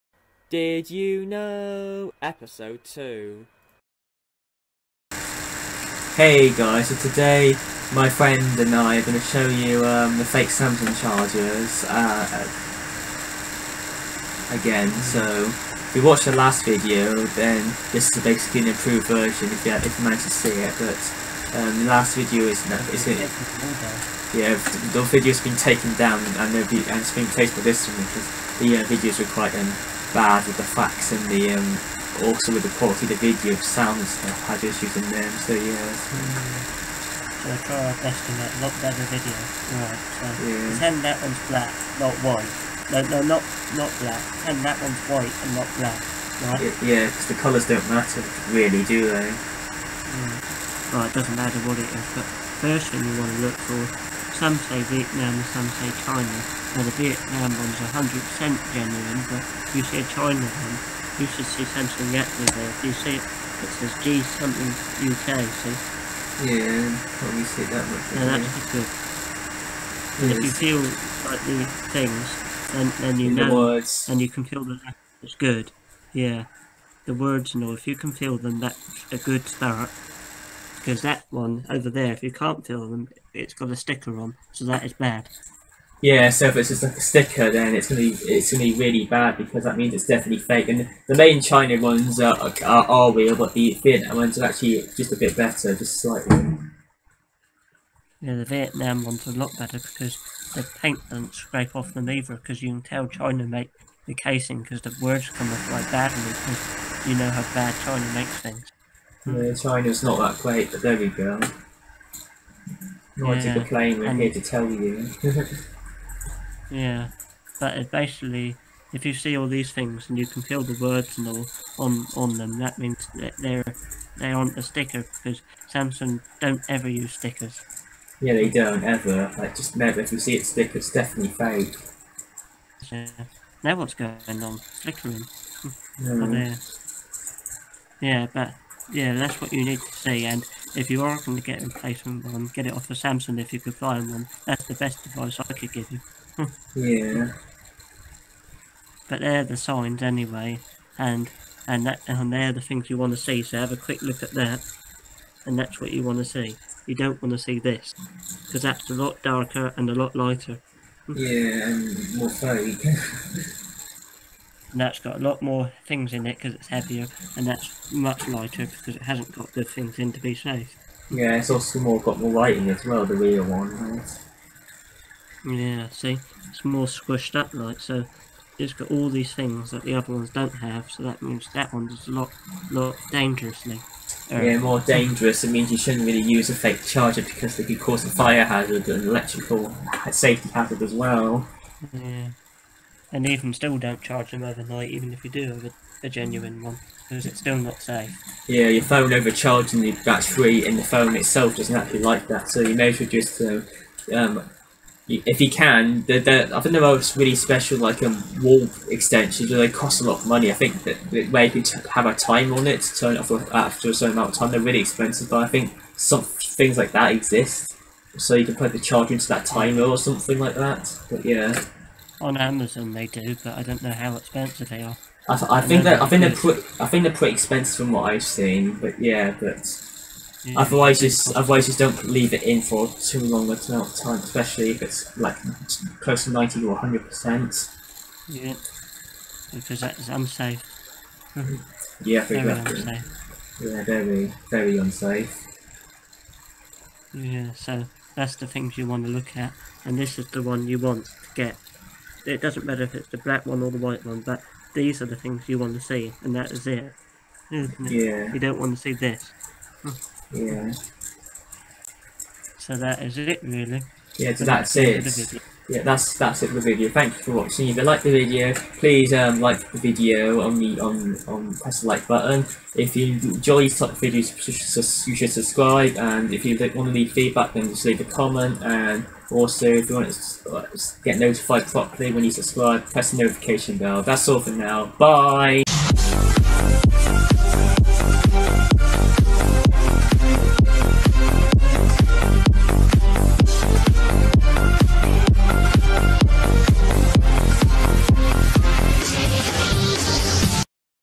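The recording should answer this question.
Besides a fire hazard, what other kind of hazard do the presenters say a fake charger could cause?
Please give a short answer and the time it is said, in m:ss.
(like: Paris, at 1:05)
Electrical safety hazard, at 3:09.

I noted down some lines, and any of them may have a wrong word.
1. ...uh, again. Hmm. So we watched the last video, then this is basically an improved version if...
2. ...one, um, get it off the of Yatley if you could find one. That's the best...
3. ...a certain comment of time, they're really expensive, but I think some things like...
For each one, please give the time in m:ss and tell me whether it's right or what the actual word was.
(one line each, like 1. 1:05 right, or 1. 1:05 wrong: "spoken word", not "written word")
1. 0:11 right
2. 2:22 wrong: "Samsung", not "Yatley"
3. 3:33 wrong: "amount", not "comment".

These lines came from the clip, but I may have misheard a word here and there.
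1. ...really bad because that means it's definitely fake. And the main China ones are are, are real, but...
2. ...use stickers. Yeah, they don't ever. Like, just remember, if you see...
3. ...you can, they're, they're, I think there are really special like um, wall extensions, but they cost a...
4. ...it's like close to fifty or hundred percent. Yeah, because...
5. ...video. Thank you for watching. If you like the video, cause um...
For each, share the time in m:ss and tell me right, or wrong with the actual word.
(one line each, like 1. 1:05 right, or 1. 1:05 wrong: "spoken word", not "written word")
1. 1:28 right
2. 2:06 right
3. 3:25 right
4. 3:54 wrong: "ninety", not "fifty"
5. 4:26 wrong: "please", not "cause".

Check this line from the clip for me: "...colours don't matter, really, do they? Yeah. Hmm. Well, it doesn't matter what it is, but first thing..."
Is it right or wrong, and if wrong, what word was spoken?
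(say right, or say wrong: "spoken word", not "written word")
right.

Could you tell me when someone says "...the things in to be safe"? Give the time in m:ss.
2:49.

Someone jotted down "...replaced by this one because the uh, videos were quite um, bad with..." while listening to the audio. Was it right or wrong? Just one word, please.
right.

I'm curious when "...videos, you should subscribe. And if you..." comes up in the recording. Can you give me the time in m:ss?
4:34.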